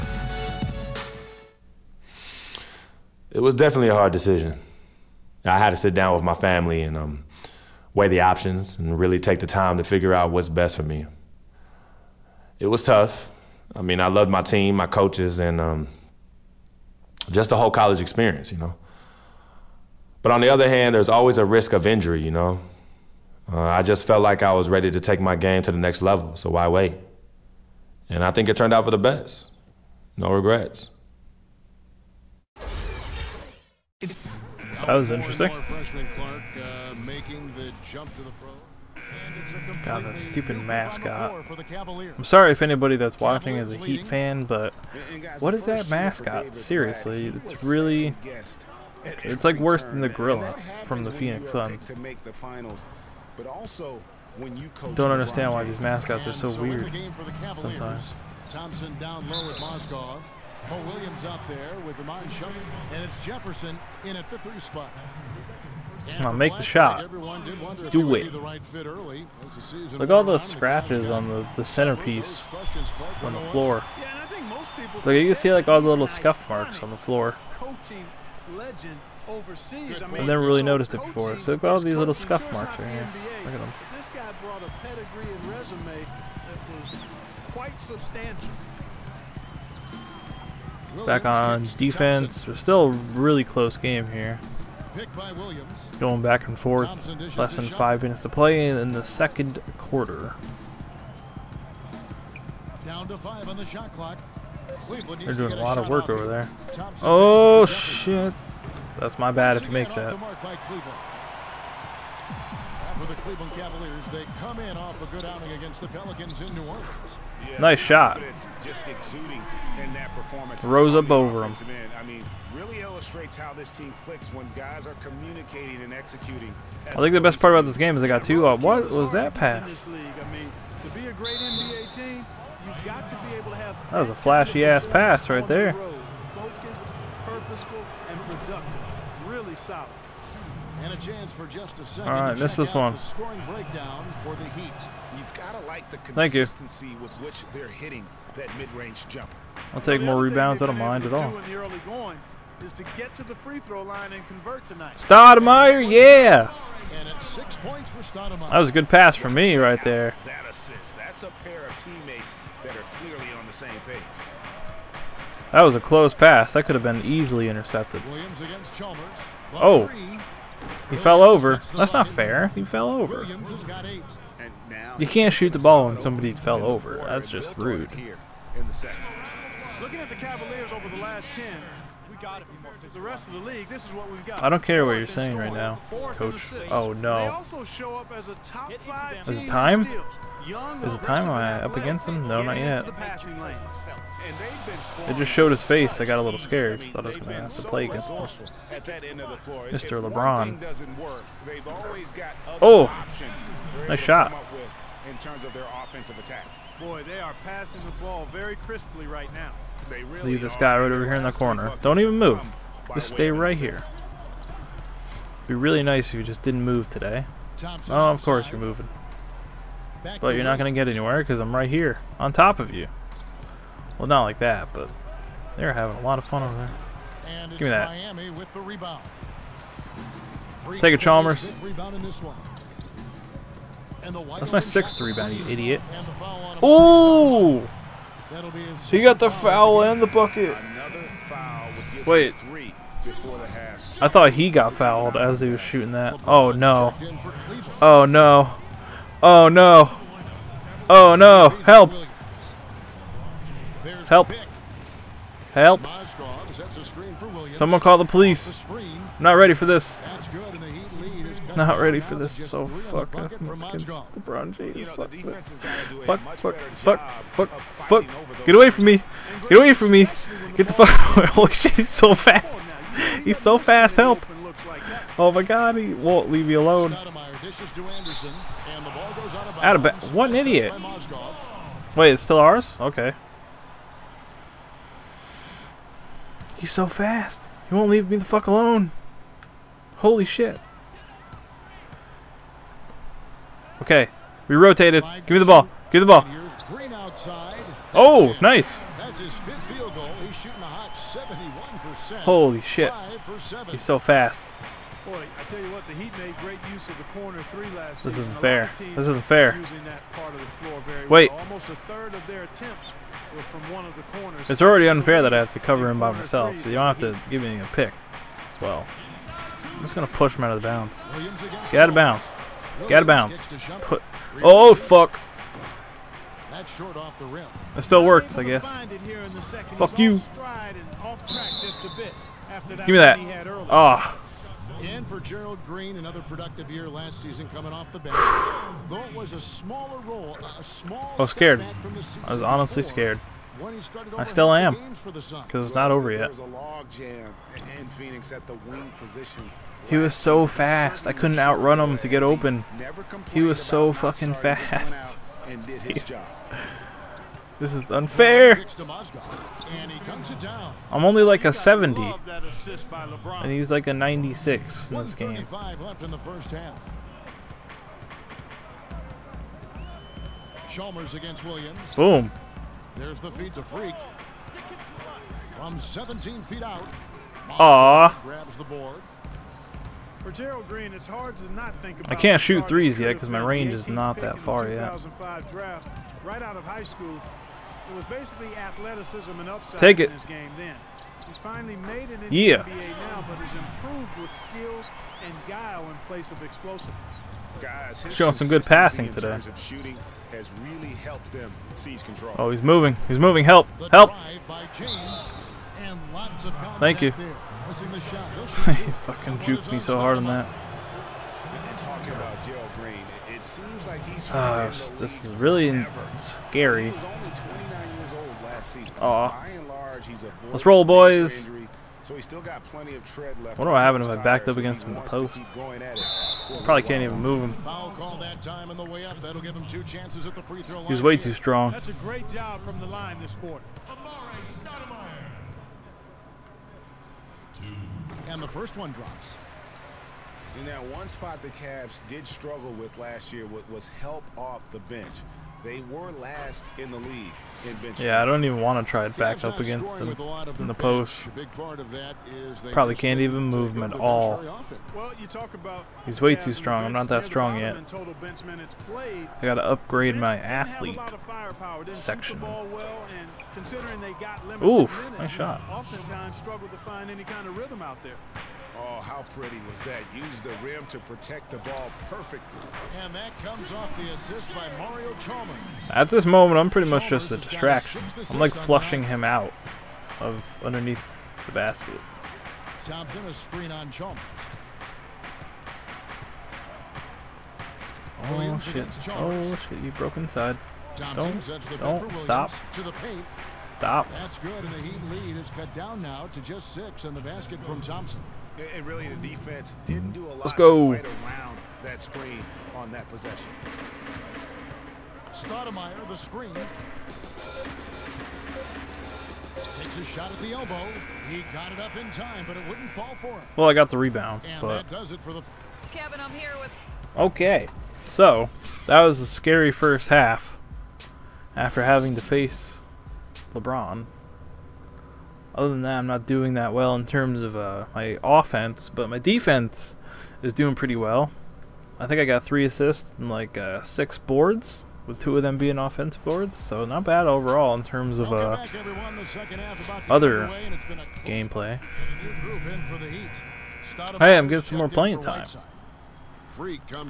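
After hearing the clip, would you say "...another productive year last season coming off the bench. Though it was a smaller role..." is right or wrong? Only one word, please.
right.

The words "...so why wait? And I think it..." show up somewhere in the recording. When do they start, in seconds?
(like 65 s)
26 s.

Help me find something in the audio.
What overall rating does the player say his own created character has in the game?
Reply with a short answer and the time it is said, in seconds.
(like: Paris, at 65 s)
70, at 361 s.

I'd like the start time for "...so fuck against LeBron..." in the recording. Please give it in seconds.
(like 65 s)
262 s.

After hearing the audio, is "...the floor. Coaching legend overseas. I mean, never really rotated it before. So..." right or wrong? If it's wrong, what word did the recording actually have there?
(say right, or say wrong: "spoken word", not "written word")
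wrong: "noticed", not "rotated".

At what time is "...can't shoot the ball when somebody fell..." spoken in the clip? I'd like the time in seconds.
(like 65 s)
175 s.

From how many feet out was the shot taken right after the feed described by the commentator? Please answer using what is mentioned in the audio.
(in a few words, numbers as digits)
17 feet.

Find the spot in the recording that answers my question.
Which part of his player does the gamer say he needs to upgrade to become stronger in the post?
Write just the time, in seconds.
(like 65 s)
460 s.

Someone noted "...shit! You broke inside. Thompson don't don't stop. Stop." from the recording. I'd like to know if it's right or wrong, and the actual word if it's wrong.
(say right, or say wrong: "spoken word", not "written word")
right.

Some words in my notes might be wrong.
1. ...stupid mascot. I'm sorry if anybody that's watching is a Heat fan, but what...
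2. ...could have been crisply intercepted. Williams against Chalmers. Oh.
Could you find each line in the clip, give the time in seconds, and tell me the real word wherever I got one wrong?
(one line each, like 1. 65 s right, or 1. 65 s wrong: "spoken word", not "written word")
1. 40 s right
2. 166 s wrong: "easily", not "crisply".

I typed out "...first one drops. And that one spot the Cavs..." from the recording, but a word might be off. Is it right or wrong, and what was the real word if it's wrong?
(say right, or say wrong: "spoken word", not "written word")
right.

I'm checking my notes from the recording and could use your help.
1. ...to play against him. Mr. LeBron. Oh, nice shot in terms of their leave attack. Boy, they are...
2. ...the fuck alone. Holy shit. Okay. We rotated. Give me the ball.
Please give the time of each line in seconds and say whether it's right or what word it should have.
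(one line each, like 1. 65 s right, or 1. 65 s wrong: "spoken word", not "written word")
1. 197 s wrong: "offensive", not "leave"
2. 288 s right.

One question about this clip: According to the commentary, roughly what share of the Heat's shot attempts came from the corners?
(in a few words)
Almost a third.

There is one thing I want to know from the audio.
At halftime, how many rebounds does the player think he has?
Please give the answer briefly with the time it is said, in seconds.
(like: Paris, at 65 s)
6, at 533 s.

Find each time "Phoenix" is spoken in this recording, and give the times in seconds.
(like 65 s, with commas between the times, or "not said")
51 s, 347 s.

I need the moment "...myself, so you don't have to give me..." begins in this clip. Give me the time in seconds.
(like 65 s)
316 s.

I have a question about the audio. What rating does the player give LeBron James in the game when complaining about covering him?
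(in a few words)
96.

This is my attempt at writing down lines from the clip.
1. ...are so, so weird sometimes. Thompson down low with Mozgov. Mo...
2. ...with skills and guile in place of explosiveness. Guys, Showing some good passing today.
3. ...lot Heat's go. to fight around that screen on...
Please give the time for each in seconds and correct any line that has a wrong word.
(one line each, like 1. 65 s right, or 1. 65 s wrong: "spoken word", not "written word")
1. 56 s right
2. 394 s right
3. 500 s wrong: "Let", not "Heat".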